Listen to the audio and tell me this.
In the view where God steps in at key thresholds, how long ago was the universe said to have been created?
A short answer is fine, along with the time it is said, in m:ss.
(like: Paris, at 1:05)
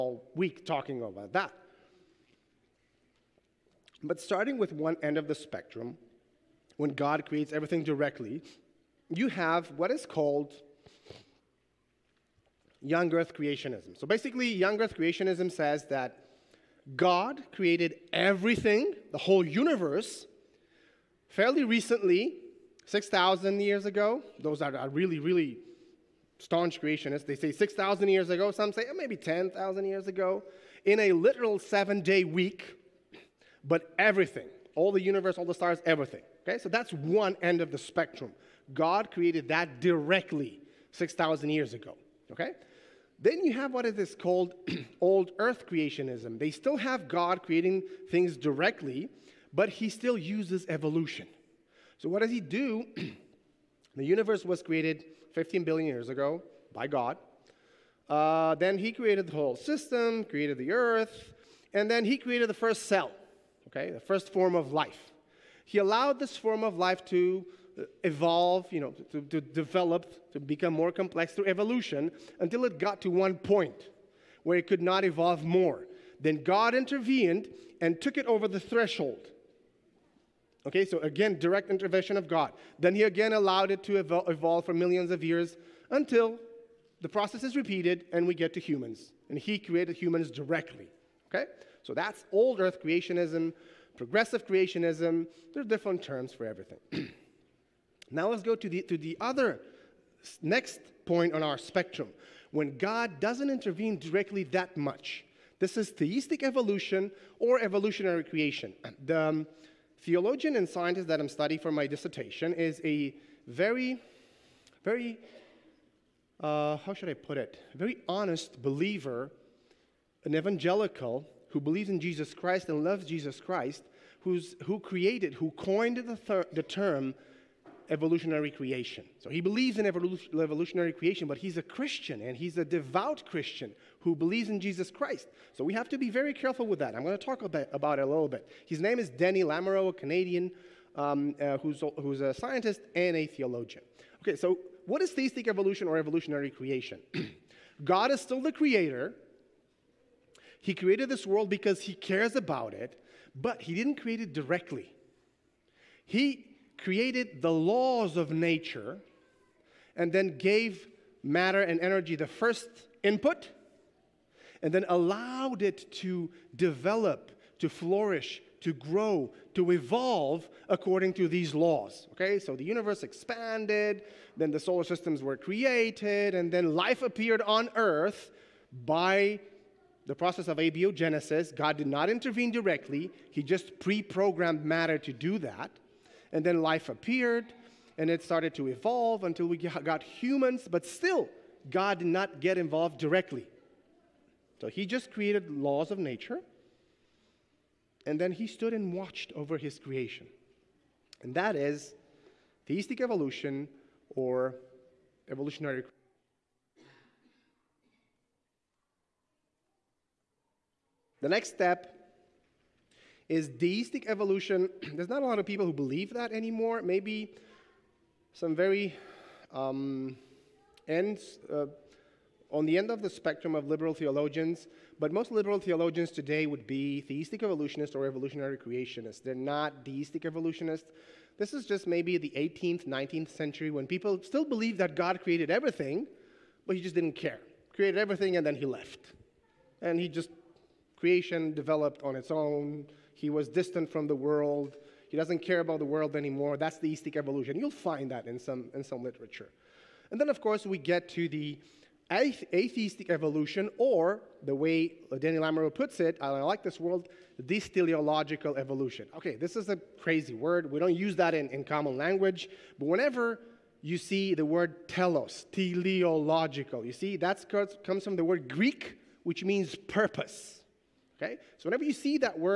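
15 billion years ago, at 0:55.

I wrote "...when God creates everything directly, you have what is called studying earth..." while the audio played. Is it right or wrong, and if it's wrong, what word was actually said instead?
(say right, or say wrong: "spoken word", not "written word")
wrong: "young", not "studying".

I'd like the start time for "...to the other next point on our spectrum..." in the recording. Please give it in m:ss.
1:38.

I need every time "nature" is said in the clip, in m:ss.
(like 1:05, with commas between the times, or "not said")
2:38, 3:15.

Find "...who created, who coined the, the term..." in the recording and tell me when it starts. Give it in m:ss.
2:04.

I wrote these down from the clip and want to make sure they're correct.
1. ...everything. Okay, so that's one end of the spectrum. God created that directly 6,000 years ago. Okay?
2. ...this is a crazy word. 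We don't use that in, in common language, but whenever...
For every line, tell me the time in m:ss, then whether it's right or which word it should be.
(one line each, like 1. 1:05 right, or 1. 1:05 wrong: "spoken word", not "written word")
1. 0:35 right
2. 4:19 right.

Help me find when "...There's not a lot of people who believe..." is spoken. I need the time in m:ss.
3:34.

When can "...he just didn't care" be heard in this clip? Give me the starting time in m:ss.
3:56.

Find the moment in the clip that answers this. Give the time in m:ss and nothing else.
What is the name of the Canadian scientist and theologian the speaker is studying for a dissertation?
2:19.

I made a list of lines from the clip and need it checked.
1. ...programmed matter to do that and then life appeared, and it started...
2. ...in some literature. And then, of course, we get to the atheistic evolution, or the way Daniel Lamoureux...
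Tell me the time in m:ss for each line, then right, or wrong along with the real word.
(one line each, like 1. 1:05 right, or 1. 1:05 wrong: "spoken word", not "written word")
1. 3:04 right
2. 4:08 right.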